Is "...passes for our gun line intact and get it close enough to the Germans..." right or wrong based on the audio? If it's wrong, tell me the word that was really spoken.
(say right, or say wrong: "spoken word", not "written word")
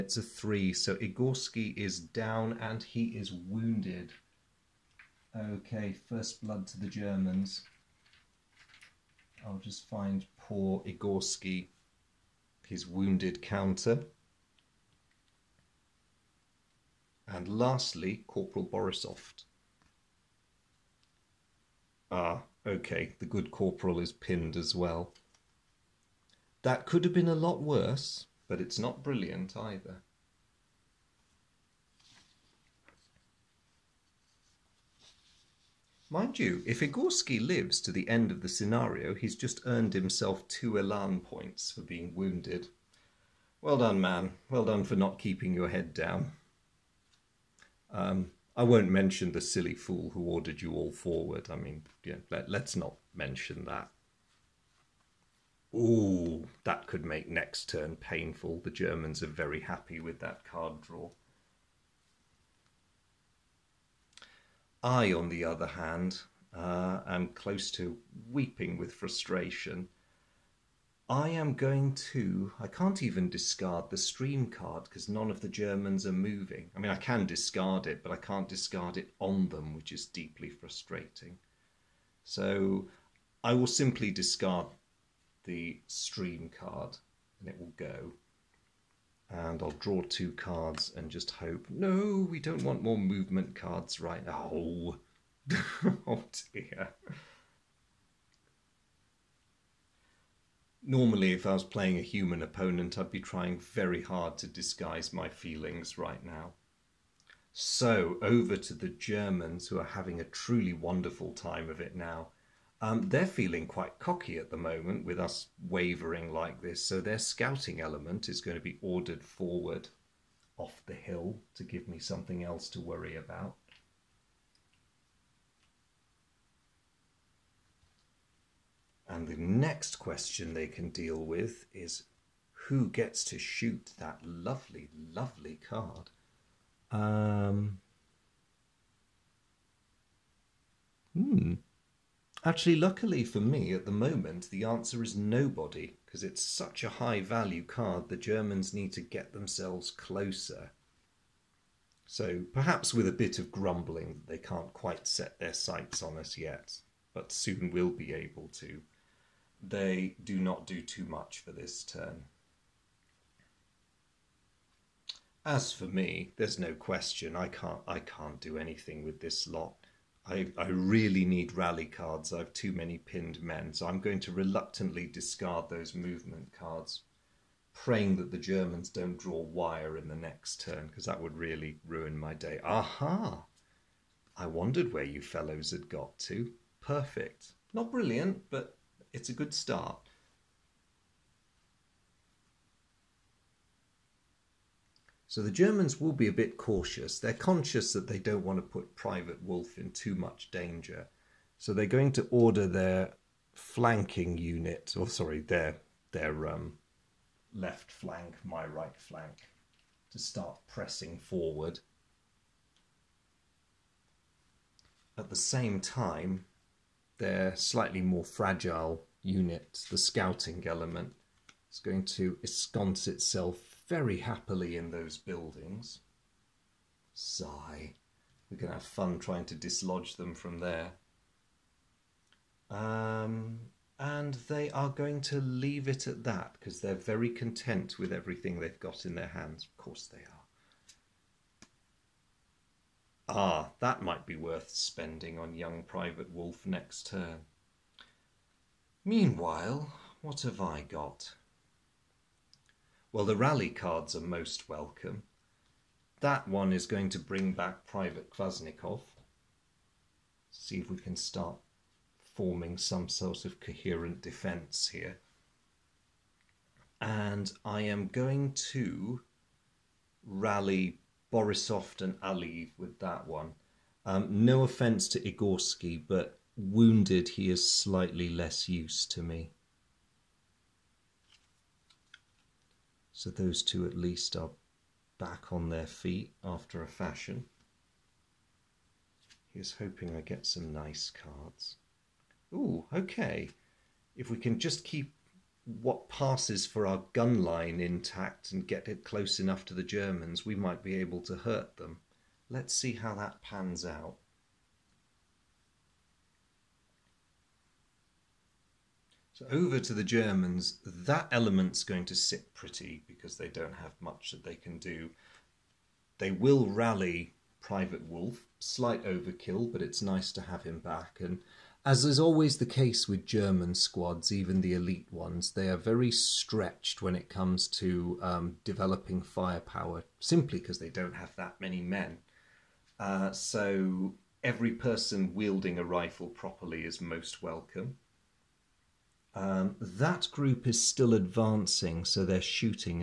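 right.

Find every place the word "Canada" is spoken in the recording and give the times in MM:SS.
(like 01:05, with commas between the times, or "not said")
not said.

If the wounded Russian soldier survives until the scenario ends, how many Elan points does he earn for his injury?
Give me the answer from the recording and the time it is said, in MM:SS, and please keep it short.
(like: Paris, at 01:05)
2, at 00:40.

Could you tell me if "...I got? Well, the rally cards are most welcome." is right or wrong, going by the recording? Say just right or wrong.
right.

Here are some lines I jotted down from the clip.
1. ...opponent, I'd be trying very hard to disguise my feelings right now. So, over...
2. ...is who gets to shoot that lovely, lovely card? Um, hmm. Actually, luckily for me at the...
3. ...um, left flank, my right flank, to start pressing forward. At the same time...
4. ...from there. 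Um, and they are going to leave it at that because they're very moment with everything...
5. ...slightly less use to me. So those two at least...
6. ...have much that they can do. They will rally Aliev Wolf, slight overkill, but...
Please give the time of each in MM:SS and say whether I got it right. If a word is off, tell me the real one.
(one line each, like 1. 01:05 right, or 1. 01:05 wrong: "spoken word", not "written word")
1. 01:42 right
2. 02:11 right
3. 03:26 right
4. 03:50 wrong: "content", not "moment"
5. 04:37 right
6. 05:13 wrong: "Private", not "Aliev".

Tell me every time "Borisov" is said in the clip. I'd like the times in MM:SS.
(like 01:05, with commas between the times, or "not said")
00:18, 04:31.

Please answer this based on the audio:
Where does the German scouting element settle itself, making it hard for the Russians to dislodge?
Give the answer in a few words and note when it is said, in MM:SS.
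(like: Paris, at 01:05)
buildings, at 03:45.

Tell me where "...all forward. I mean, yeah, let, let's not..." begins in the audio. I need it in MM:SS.
00:50.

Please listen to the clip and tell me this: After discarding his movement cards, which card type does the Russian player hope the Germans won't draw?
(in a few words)
wire.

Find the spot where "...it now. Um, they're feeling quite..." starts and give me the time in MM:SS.
01:51.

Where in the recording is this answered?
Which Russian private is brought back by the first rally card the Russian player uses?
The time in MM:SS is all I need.
04:17.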